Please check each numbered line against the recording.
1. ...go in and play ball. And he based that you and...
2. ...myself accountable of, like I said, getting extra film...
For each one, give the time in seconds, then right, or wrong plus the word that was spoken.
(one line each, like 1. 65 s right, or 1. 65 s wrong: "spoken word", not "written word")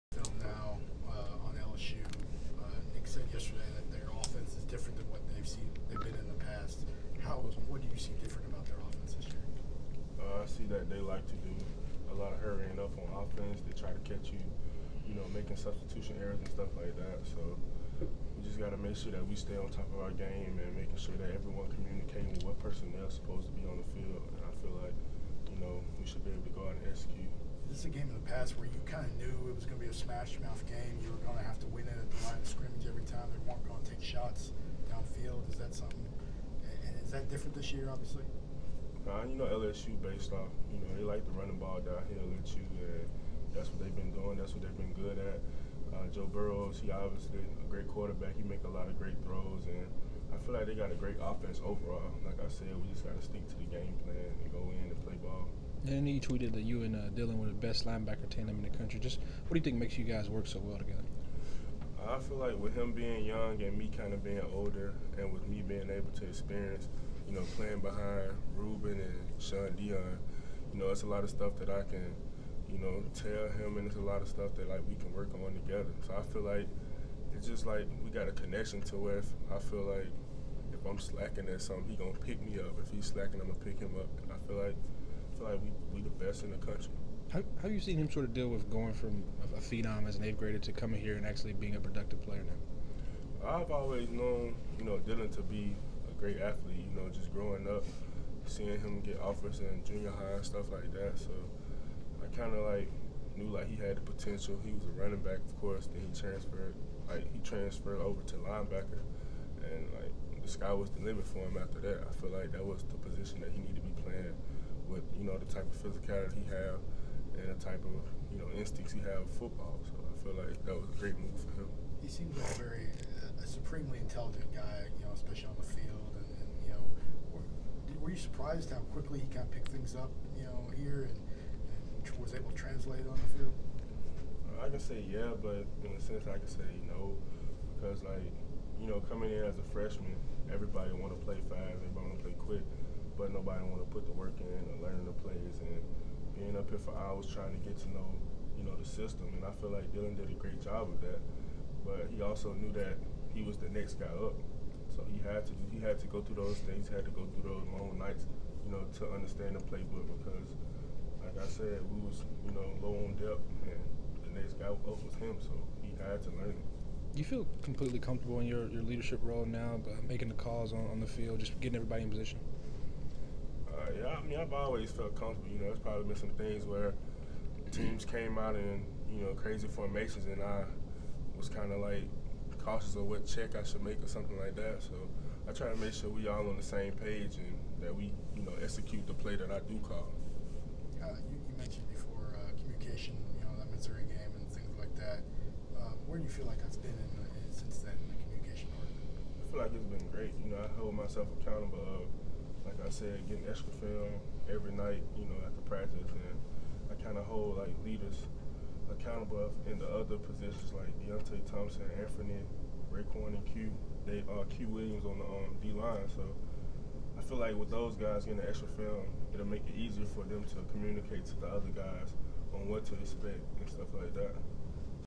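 1. 54 s wrong: "tweeted", not "based"
2. 200 s right.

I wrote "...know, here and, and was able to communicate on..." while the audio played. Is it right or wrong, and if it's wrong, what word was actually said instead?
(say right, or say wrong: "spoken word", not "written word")
wrong: "translate", not "communicate".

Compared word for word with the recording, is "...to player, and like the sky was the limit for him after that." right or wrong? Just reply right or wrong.
wrong.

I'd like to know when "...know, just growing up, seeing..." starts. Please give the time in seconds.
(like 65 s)
97 s.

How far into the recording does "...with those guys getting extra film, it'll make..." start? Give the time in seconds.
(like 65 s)
217 s.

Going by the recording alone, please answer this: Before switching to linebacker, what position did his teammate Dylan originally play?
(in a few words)
Running back.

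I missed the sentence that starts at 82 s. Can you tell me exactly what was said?
If he's slacking, I'm gonna pick him up.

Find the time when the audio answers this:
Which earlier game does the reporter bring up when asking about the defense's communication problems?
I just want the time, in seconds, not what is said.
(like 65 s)
193 s.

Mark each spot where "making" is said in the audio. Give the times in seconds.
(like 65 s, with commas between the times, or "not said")
15 s, 20 s, 170 s.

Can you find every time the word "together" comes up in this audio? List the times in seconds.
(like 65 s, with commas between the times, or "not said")
60 s, 75 s.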